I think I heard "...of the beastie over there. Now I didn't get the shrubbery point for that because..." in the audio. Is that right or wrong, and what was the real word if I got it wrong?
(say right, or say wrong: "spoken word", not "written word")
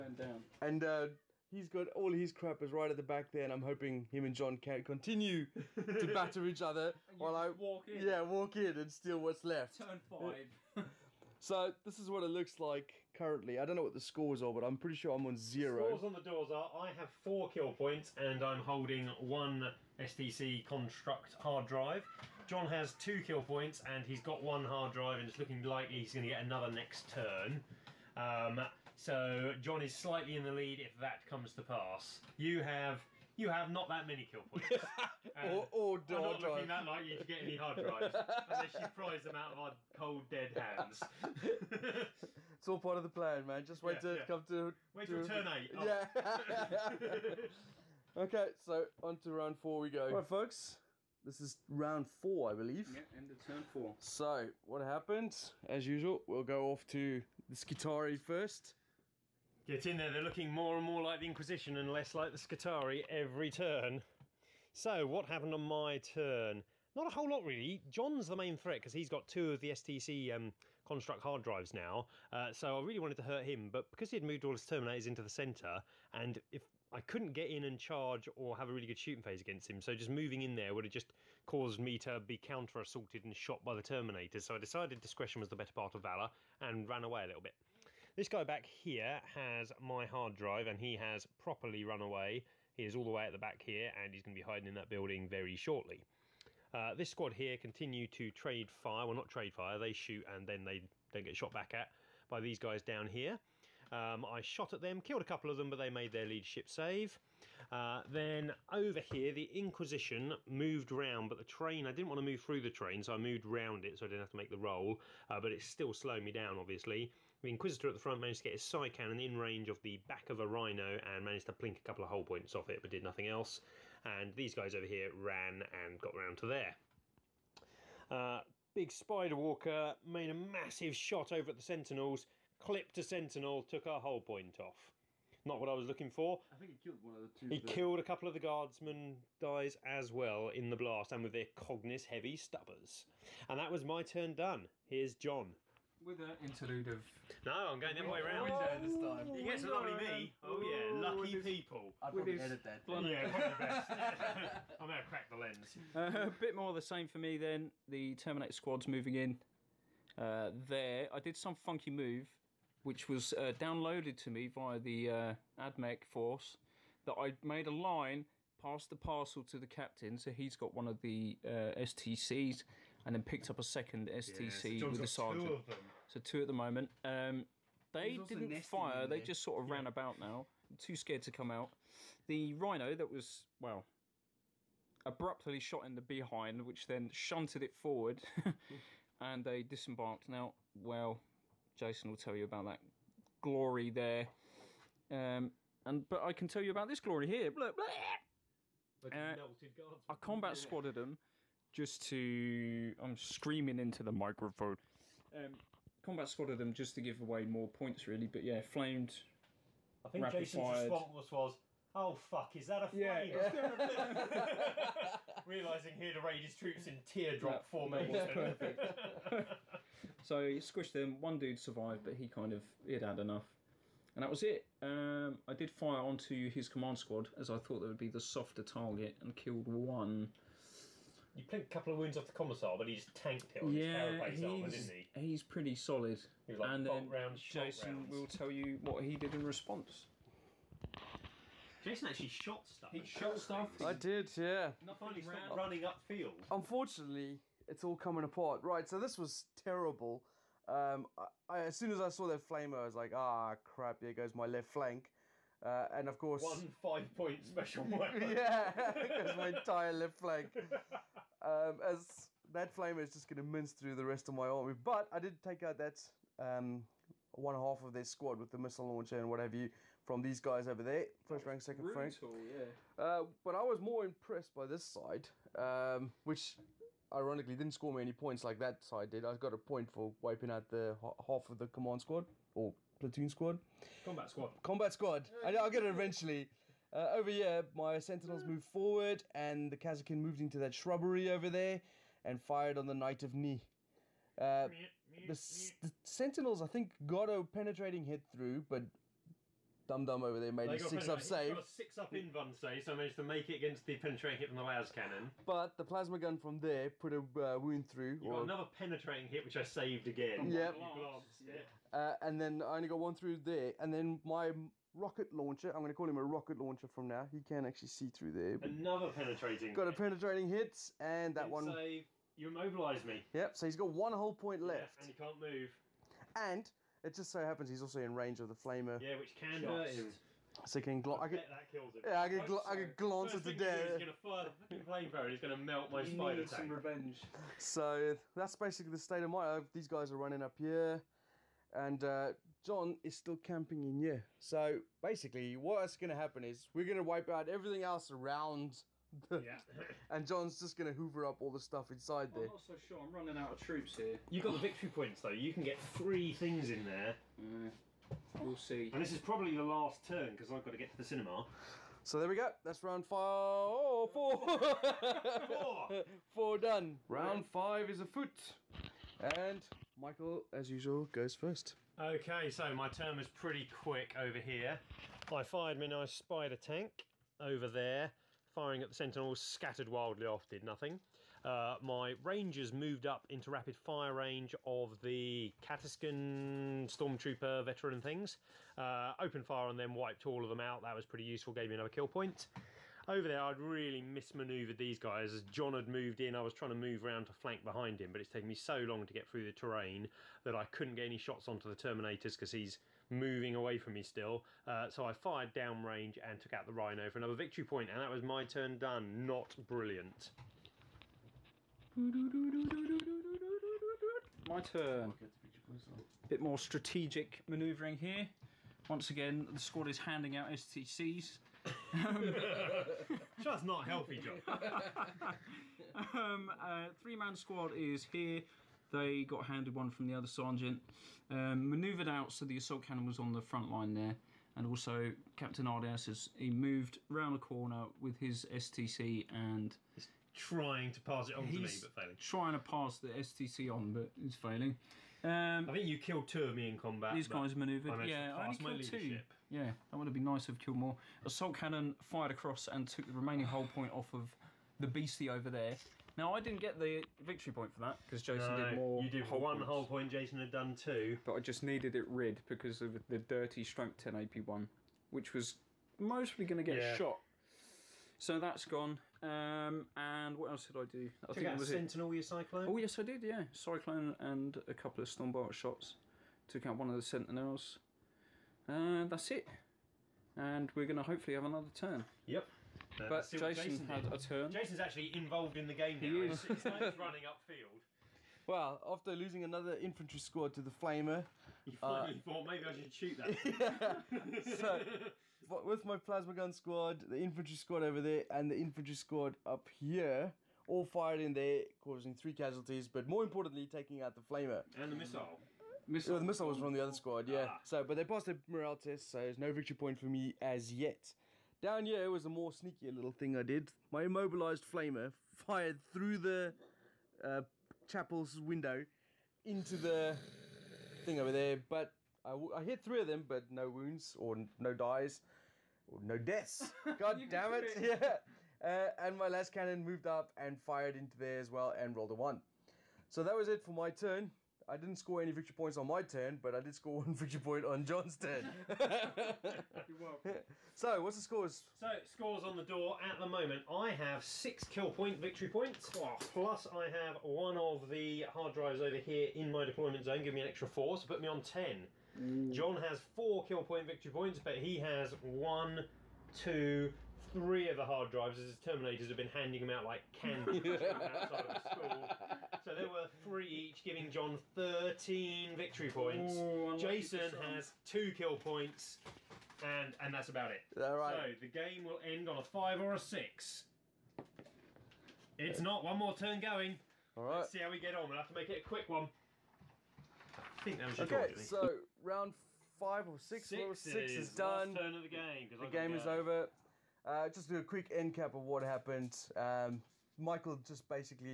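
wrong: "victory", not "shrubbery".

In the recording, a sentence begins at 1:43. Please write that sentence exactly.
Um, I shot at them, killed a couple of them, but they made their leadership save.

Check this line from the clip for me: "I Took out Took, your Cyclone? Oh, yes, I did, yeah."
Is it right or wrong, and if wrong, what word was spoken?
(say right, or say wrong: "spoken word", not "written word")
wrong: "Sentinel", not "Took".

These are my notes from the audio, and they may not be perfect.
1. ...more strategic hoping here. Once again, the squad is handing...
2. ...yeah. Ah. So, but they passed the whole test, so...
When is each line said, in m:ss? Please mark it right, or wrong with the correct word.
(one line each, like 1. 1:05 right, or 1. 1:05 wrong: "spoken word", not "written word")
1. 6:56 wrong: "manoeuvring", not "hoping"
2. 8:27 wrong: "morale", not "whole".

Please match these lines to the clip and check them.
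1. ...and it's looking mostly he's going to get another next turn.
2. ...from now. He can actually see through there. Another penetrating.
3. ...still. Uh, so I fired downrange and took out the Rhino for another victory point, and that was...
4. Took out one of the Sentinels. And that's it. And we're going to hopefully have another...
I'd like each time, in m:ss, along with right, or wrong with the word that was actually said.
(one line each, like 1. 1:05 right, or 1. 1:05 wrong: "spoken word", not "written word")
1. 0:25 wrong: "likely", not "mostly"
2. 5:16 right
3. 6:44 right
4. 7:56 right.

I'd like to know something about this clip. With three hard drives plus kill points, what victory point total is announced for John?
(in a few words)
13.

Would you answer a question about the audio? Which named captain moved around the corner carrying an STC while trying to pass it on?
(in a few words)
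Captain Ardias.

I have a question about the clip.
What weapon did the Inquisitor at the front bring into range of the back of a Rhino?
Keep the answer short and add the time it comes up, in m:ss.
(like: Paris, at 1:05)
psycannon, at 1:58.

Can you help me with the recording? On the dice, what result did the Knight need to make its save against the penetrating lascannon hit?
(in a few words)
6.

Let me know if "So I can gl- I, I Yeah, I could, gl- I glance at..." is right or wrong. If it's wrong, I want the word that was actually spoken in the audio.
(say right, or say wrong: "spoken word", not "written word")
right.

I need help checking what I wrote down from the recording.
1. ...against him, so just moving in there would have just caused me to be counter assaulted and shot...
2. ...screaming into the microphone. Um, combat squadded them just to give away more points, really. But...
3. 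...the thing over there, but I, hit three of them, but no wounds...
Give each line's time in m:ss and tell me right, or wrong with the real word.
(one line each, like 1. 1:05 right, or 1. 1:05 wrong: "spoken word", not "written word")
1. 1:19 right
2. 3:23 right
3. 8:39 right.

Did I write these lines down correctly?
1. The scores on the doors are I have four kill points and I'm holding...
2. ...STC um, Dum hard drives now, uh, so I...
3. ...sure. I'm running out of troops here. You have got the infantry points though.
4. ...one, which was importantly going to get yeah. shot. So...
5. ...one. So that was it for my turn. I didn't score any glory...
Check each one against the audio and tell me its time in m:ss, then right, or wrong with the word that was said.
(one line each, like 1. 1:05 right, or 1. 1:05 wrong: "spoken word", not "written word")
1. 0:15 right
2. 1:09 wrong: "Construct", not "Dum"
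3. 5:52 wrong: "victory", not "infantry"
4. 7:44 wrong: "mostly", not "importantly"
5. 8:52 wrong: "victory", not "glory".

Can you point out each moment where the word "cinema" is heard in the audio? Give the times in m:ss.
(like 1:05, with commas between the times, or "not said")
6:01.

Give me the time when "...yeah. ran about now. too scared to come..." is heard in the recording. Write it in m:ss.
2:59.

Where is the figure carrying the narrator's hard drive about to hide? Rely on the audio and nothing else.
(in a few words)
in that building.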